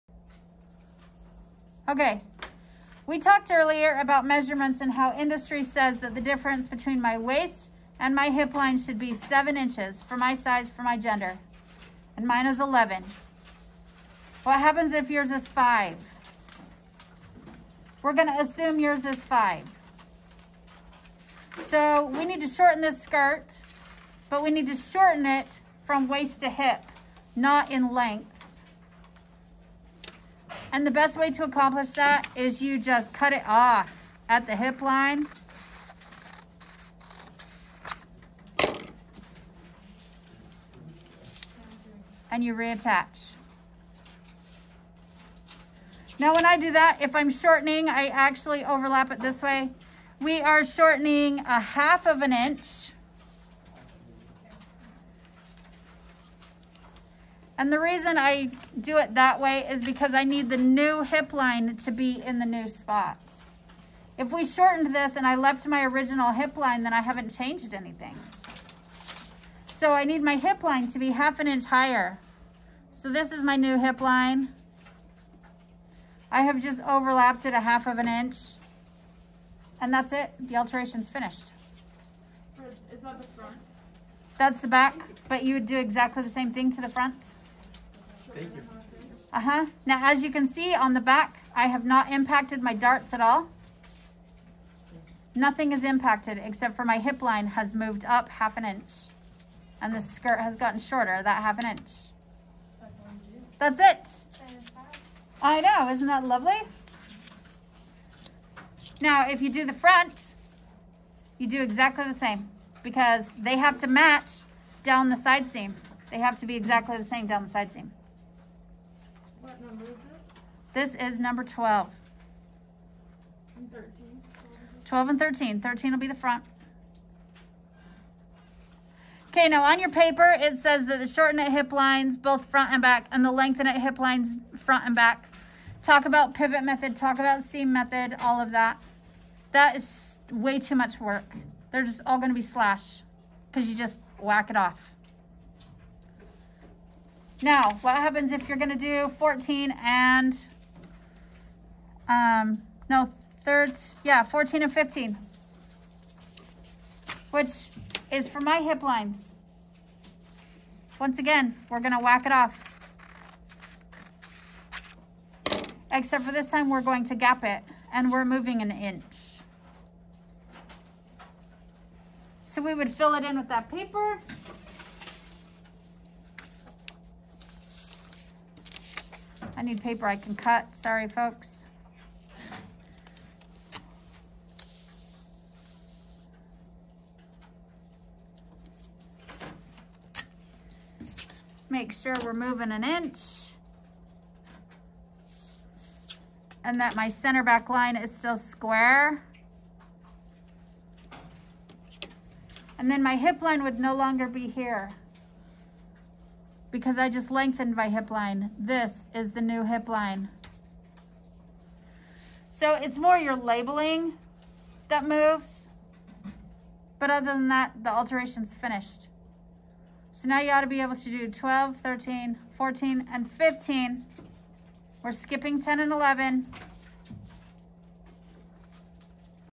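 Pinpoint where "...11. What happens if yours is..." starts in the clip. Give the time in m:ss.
0:12.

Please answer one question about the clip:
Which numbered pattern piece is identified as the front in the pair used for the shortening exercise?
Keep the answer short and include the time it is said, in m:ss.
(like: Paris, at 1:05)
13, at 2:05.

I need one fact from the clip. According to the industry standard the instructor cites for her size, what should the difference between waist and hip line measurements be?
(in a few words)
7 inches.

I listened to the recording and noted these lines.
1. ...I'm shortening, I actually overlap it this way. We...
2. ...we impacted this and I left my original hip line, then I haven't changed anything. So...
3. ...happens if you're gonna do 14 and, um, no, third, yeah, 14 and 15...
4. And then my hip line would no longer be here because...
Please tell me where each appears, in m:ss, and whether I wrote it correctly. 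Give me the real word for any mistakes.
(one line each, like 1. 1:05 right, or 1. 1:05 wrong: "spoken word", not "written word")
1. 0:47 right
2. 1:04 wrong: "shortened", not "impacted"
3. 2:27 right
4. 3:22 right.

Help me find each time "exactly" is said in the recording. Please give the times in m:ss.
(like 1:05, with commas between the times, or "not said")
1:25, 1:51, 1:56.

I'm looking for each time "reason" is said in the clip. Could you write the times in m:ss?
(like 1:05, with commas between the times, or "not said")
0:57.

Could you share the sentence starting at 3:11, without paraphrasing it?
Make sure we're moving an inch.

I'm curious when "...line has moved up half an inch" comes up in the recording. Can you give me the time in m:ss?
1:37.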